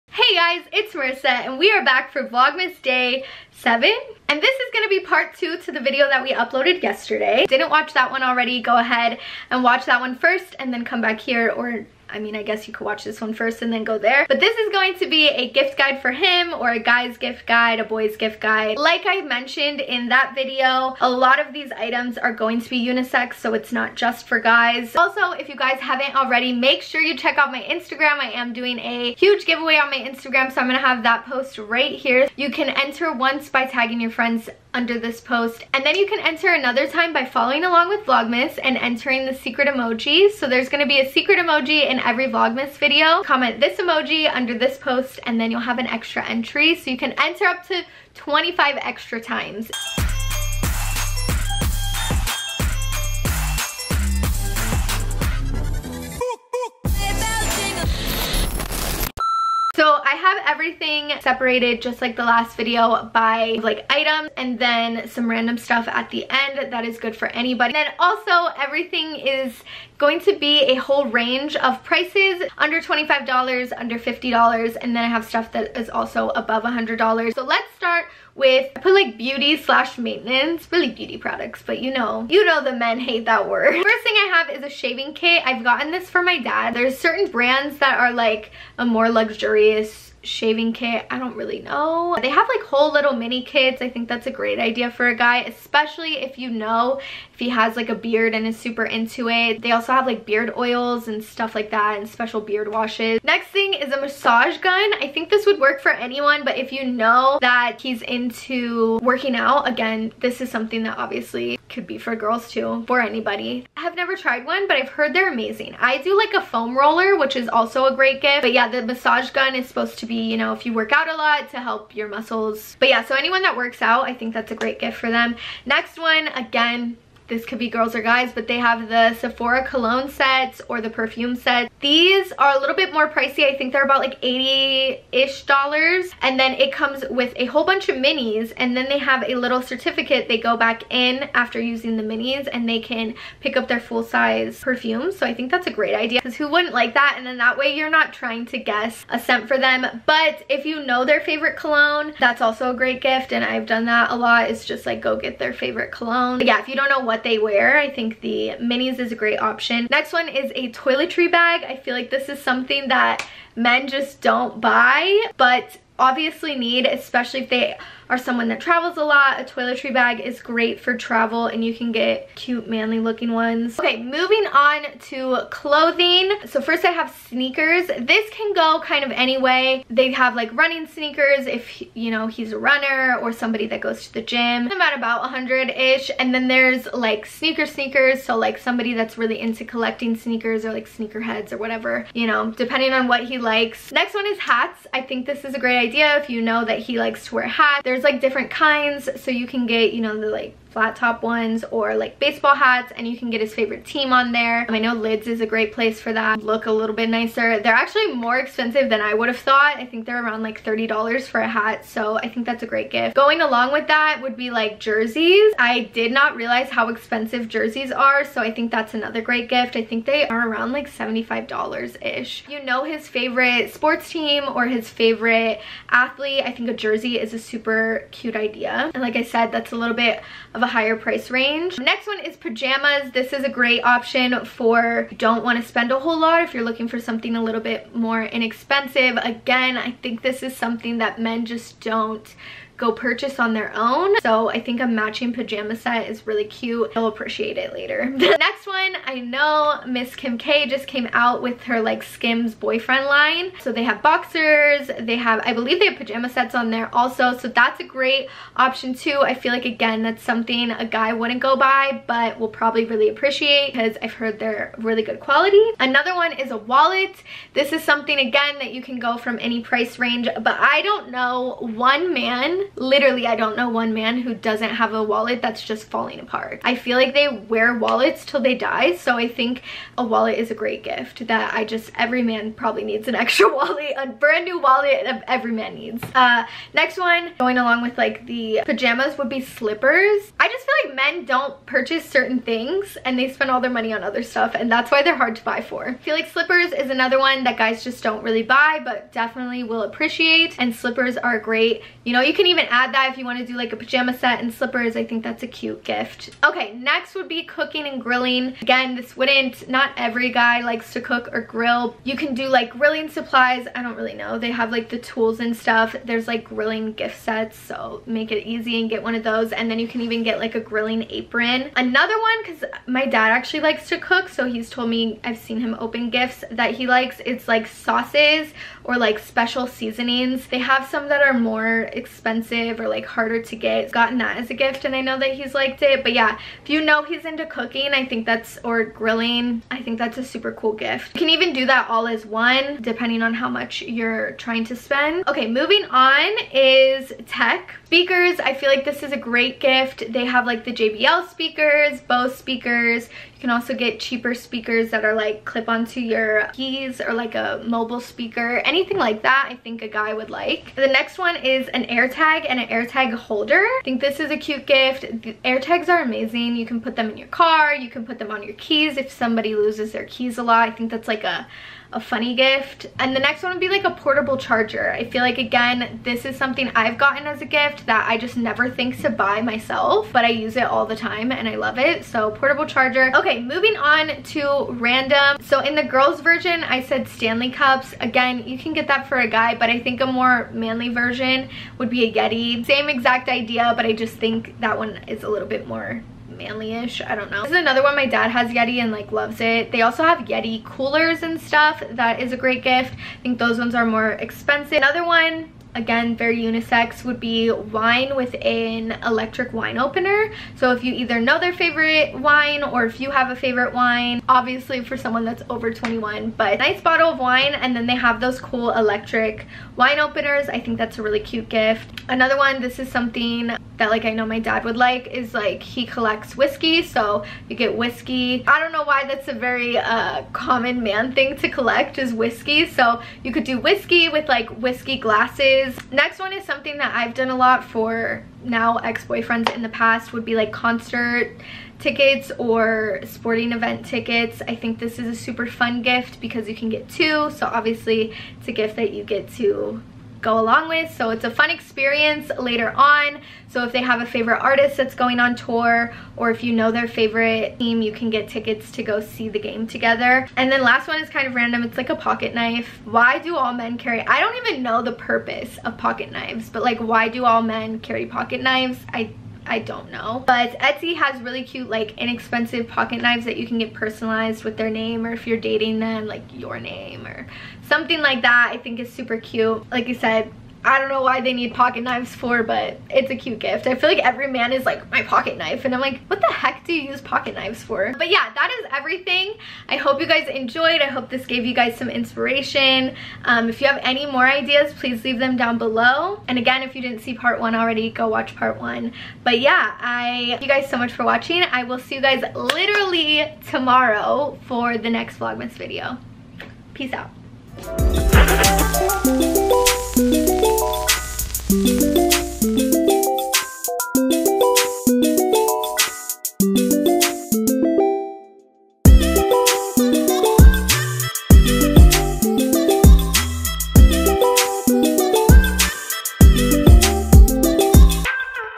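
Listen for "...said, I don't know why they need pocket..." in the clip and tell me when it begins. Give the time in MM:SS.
07:59.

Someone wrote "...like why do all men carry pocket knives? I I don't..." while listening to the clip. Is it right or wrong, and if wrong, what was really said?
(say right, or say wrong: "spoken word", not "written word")
right.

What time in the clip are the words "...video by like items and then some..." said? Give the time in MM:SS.
01:02.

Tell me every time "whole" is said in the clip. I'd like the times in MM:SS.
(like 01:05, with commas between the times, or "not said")
01:10, 01:32, 02:17, 03:55.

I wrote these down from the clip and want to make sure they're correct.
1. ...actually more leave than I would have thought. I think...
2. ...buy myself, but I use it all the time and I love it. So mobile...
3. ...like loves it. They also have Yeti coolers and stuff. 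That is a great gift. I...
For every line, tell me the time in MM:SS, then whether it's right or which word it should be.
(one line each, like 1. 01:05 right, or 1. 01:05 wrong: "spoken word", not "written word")
1. 03:27 wrong: "expensive", not "leave"
2. 06:19 wrong: "portable", not "mobile"
3. 06:38 right.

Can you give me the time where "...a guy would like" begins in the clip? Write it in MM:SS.
05:59.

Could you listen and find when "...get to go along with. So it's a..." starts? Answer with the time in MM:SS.
07:29.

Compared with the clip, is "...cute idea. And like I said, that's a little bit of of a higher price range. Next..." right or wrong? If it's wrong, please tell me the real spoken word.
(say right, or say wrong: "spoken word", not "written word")
right.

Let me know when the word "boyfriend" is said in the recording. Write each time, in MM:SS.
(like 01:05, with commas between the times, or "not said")
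04:12, 07:18.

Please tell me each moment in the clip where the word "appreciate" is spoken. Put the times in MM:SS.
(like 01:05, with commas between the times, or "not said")
04:07, 04:23, 04:59.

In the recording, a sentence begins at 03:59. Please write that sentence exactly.
Again, I think this is something that men just don't go purchase on their own.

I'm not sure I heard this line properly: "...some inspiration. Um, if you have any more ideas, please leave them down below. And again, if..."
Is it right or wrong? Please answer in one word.
right.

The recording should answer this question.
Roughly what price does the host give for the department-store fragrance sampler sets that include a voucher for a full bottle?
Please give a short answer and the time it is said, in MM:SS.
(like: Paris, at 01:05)
$80, at 02:14.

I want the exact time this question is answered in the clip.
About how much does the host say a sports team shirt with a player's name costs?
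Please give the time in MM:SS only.
03:40.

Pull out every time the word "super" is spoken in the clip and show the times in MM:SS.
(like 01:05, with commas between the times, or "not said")
01:38, 03:47, 05:40, 07:25, 07:58.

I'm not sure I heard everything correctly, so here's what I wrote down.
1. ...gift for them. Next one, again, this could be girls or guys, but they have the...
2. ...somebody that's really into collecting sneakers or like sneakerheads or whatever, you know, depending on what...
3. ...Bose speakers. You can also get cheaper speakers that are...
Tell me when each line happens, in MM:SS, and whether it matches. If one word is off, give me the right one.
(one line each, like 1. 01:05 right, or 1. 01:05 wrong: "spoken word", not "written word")
1. 02:04 right
2. 03:08 right
3. 05:52 right.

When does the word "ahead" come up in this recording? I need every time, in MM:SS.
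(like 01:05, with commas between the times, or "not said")
00:08.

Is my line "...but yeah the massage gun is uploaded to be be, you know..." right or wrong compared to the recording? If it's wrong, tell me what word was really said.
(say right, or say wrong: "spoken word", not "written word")
wrong: "supposed", not "uploaded".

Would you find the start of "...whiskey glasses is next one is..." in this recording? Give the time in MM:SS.
07:14.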